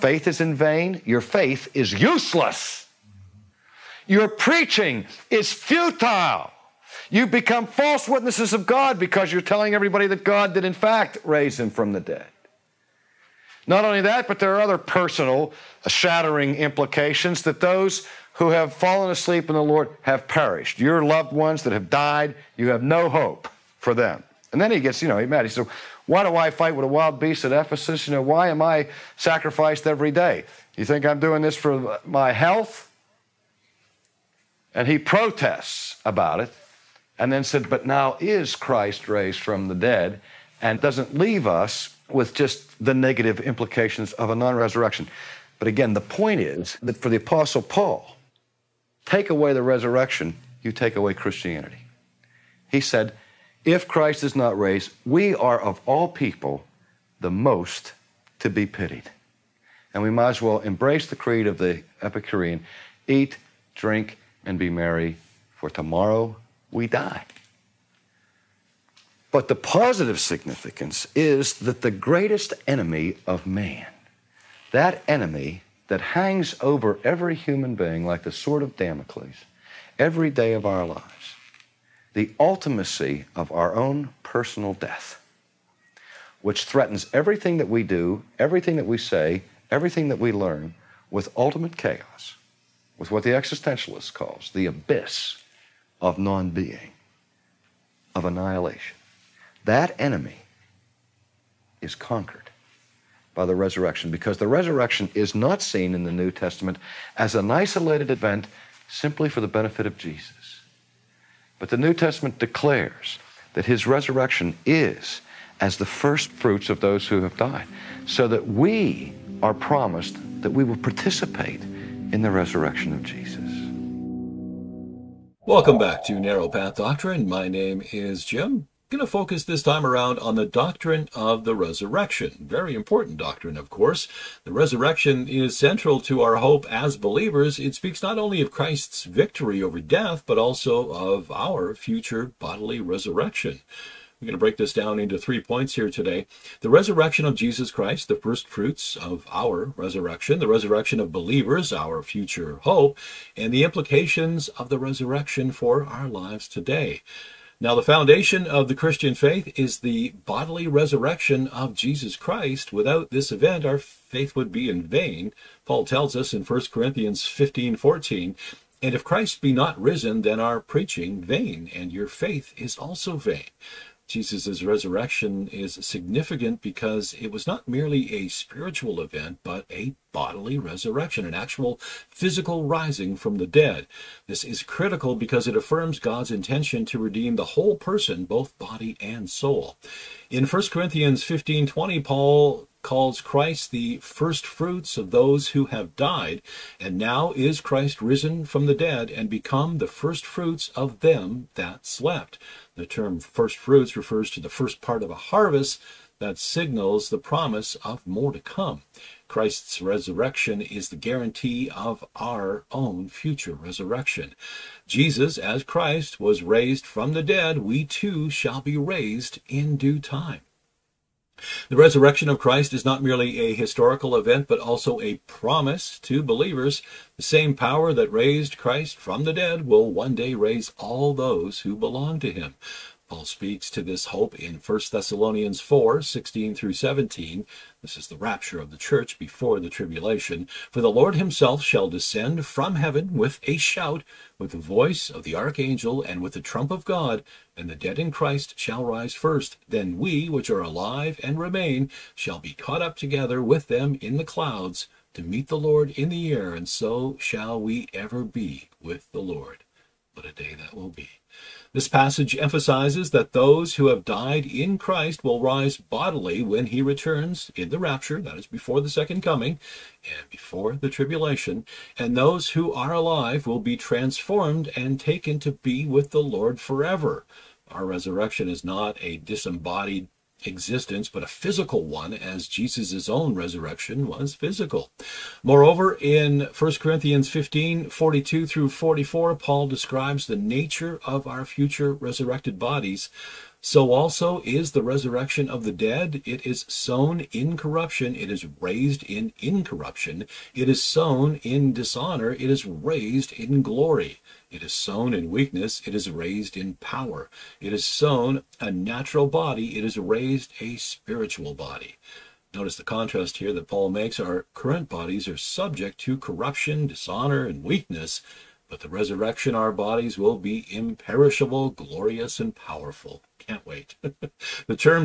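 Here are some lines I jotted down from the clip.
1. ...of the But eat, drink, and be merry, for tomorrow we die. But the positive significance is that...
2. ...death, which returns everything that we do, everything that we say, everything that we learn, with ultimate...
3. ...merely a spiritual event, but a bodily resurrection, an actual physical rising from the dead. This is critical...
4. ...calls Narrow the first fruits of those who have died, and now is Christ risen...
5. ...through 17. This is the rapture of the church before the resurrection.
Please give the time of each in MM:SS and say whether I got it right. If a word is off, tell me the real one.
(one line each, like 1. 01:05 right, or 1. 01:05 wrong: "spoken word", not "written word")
1. 01:01 wrong: "Epicurean", not "But"
2. 01:24 wrong: "threatens", not "returns"
3. 02:57 right
4. 03:12 wrong: "Christ", not "Narrow"
5. 03:56 wrong: "tribulation", not "resurrection".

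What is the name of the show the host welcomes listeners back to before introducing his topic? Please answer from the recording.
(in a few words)
Narrow Path Doctrine.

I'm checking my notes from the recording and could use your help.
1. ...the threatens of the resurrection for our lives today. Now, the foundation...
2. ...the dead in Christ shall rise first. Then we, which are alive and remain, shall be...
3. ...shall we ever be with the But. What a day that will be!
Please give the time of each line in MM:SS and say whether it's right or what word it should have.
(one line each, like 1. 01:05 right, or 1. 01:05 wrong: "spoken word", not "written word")
1. 02:33 wrong: "implications", not "threatens"
2. 04:07 right
3. 04:17 wrong: "Lord", not "But".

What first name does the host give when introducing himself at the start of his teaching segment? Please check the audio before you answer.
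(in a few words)
Jim.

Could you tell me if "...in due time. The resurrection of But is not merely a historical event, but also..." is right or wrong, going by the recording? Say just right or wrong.
wrong.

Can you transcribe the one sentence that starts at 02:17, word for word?
It speaks not only of Christ's victory over death, but also of our future bodily resurrection.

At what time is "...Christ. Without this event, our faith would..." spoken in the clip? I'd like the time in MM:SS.
02:42.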